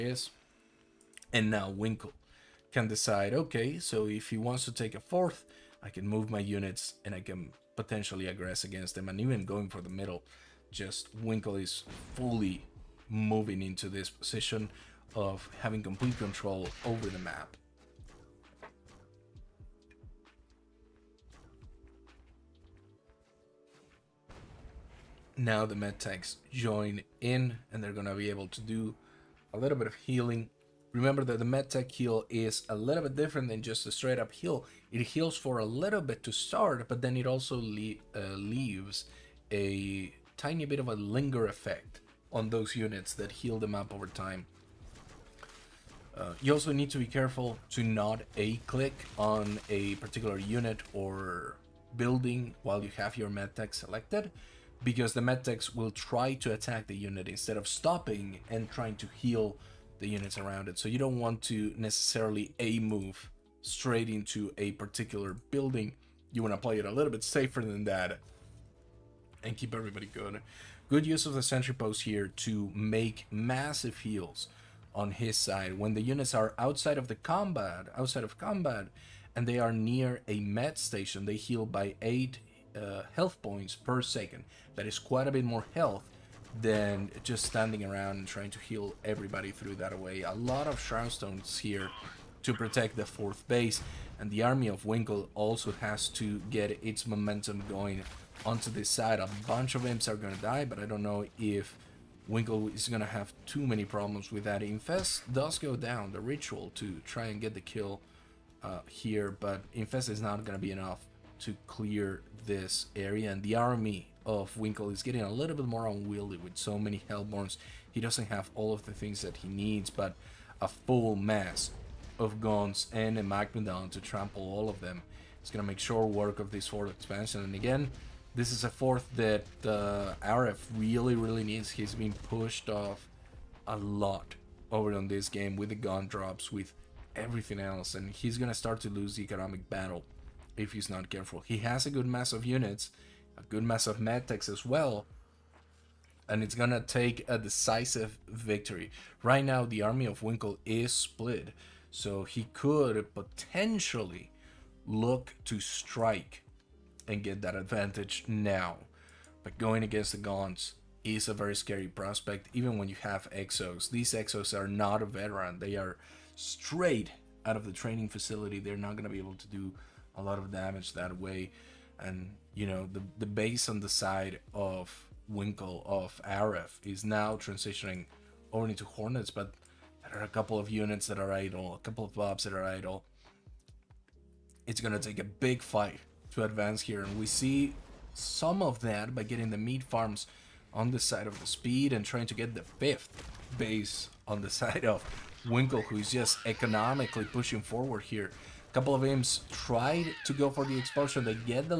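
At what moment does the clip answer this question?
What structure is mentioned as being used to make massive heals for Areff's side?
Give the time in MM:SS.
01:11.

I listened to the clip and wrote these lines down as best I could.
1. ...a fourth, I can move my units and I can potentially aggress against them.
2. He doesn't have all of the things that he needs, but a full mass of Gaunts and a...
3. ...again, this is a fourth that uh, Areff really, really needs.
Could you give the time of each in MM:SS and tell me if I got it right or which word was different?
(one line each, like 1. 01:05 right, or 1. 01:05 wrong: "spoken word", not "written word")
1. 00:04 right
2. 01:57 right
3. 02:07 right.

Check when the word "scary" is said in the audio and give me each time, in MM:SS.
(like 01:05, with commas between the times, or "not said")
02:41.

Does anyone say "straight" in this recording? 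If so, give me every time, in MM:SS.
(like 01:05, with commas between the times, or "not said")
00:33, 01:03, 02:46.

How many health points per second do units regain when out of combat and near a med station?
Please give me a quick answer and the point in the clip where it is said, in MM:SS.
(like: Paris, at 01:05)
8, at 01:22.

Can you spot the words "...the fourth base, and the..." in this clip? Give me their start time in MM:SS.
01:32.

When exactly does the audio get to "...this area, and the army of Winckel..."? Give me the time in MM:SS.
01:52.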